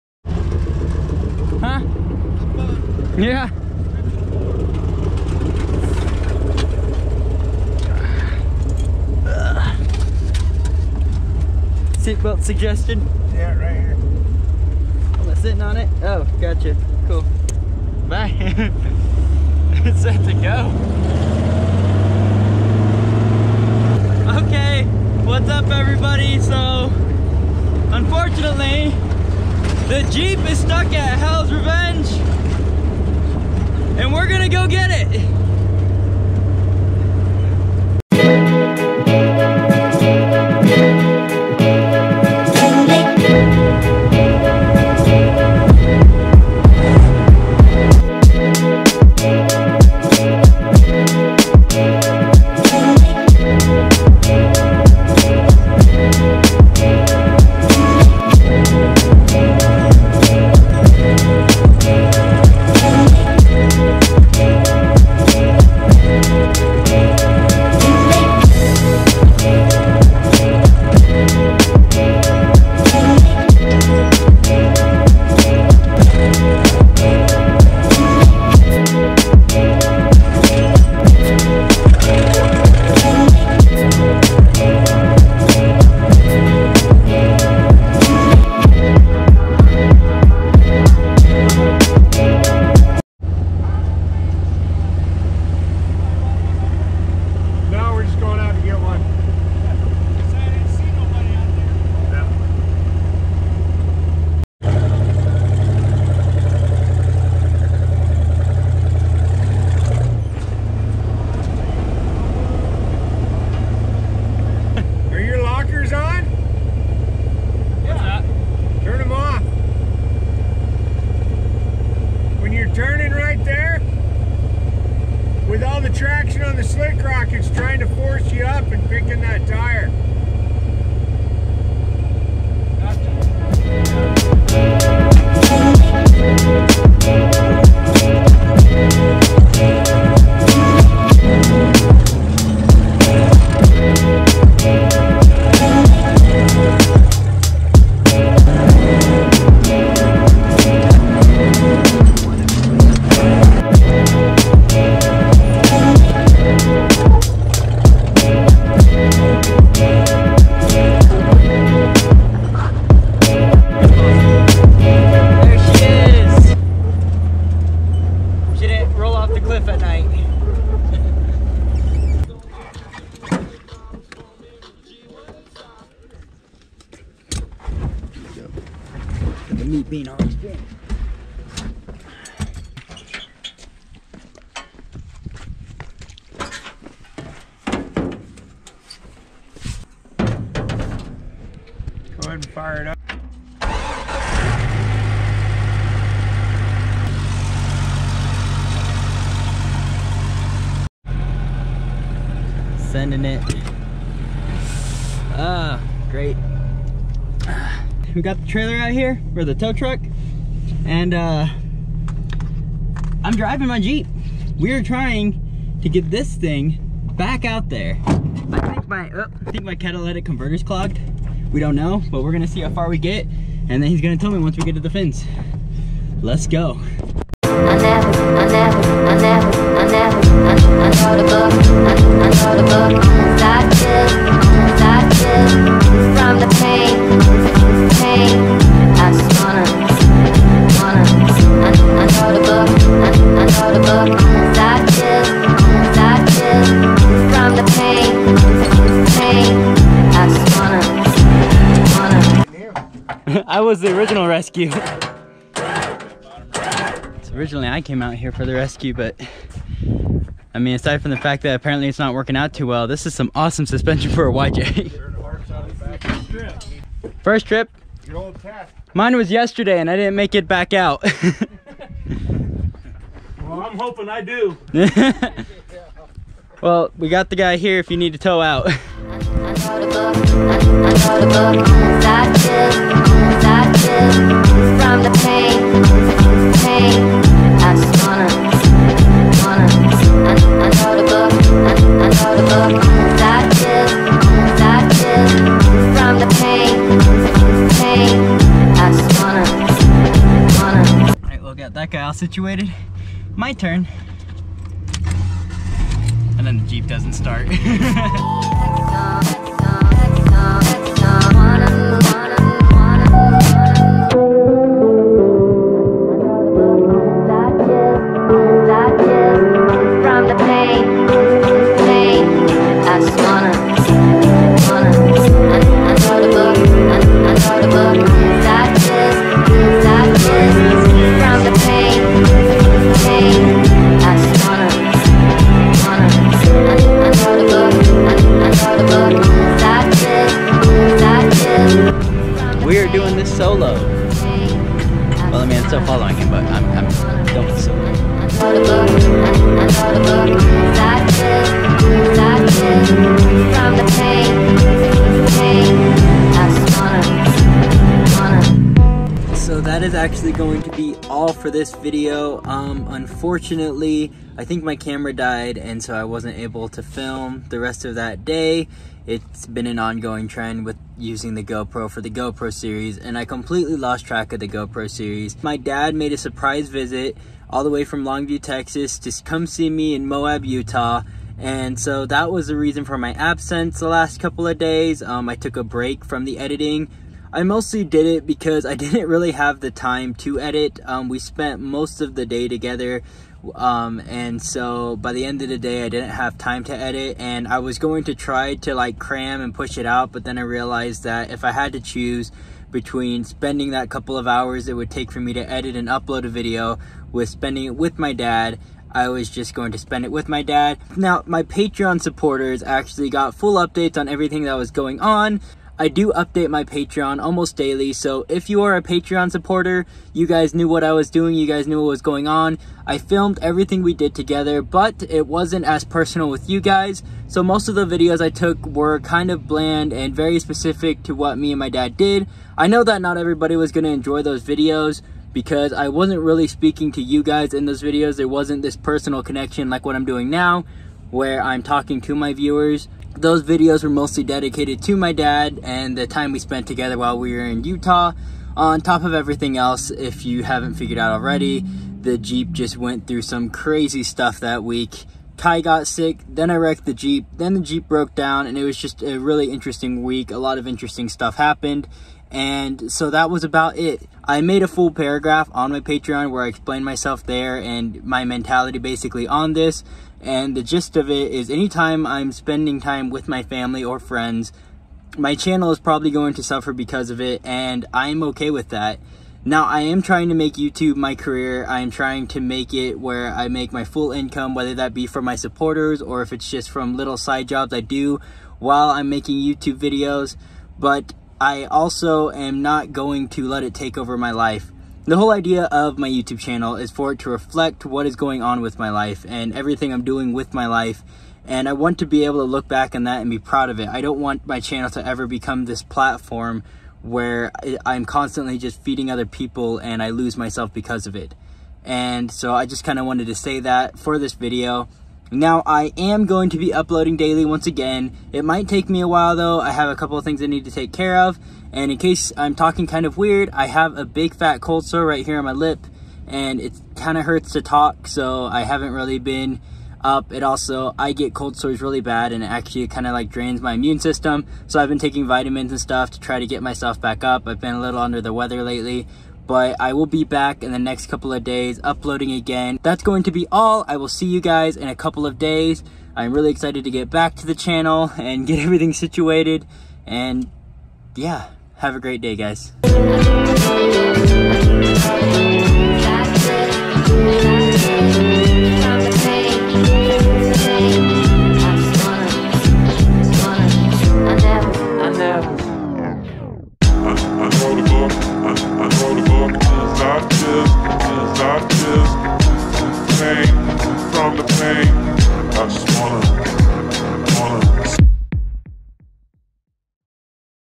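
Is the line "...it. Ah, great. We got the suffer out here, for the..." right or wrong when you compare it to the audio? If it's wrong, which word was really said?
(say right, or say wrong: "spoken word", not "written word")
wrong: "trailer", not "suffer".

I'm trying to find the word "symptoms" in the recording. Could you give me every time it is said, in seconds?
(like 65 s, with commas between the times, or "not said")
not said.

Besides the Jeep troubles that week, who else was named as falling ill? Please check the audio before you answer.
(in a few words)
Kai.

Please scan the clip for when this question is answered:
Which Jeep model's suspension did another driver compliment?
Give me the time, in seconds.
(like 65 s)
264 s.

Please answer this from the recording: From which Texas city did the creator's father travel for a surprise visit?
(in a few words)
Longview.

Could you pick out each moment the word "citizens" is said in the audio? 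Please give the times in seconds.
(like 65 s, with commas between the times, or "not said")
not said.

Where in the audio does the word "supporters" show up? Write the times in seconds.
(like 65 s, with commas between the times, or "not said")
412 s, 419 s, 485 s.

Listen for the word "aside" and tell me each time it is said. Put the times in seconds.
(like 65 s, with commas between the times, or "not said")
260 s.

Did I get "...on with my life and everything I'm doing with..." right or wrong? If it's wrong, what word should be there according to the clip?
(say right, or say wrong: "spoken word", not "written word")
right.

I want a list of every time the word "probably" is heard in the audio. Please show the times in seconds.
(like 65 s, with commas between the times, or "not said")
475 s.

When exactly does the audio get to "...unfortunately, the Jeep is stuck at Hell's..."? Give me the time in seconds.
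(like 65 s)
27 s.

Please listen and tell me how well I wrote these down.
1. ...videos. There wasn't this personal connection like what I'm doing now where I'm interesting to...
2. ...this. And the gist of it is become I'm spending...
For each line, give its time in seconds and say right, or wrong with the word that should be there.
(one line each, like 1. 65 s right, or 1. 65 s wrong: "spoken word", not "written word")
1. 437 s wrong: "talking", not "interesting"
2. 469 s wrong: "anytime", not "become".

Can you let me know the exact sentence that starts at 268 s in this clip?
Mine was yesterday and I didn't make it back out.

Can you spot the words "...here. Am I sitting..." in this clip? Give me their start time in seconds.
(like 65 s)
13 s.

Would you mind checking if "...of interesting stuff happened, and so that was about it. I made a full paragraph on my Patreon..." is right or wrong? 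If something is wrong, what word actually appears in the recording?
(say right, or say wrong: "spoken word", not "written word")
right.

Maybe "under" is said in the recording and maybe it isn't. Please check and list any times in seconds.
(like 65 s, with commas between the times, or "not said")
538 s.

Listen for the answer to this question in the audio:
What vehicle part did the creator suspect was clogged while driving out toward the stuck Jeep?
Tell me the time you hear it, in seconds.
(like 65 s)
219 s.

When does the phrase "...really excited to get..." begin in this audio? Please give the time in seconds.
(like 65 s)
546 s.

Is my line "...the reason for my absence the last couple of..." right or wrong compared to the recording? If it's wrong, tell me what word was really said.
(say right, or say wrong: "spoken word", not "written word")
right.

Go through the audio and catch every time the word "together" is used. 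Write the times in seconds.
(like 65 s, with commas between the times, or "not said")
392 s, 424 s, 446 s.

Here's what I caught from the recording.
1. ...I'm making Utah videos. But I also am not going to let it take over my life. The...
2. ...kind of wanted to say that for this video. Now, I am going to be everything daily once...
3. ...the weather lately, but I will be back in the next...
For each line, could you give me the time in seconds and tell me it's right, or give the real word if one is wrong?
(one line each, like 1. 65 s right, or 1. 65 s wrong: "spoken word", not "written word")
1. 488 s wrong: "YouTube", not "Utah"
2. 512 s wrong: "uploading", not "everything"
3. 538 s right.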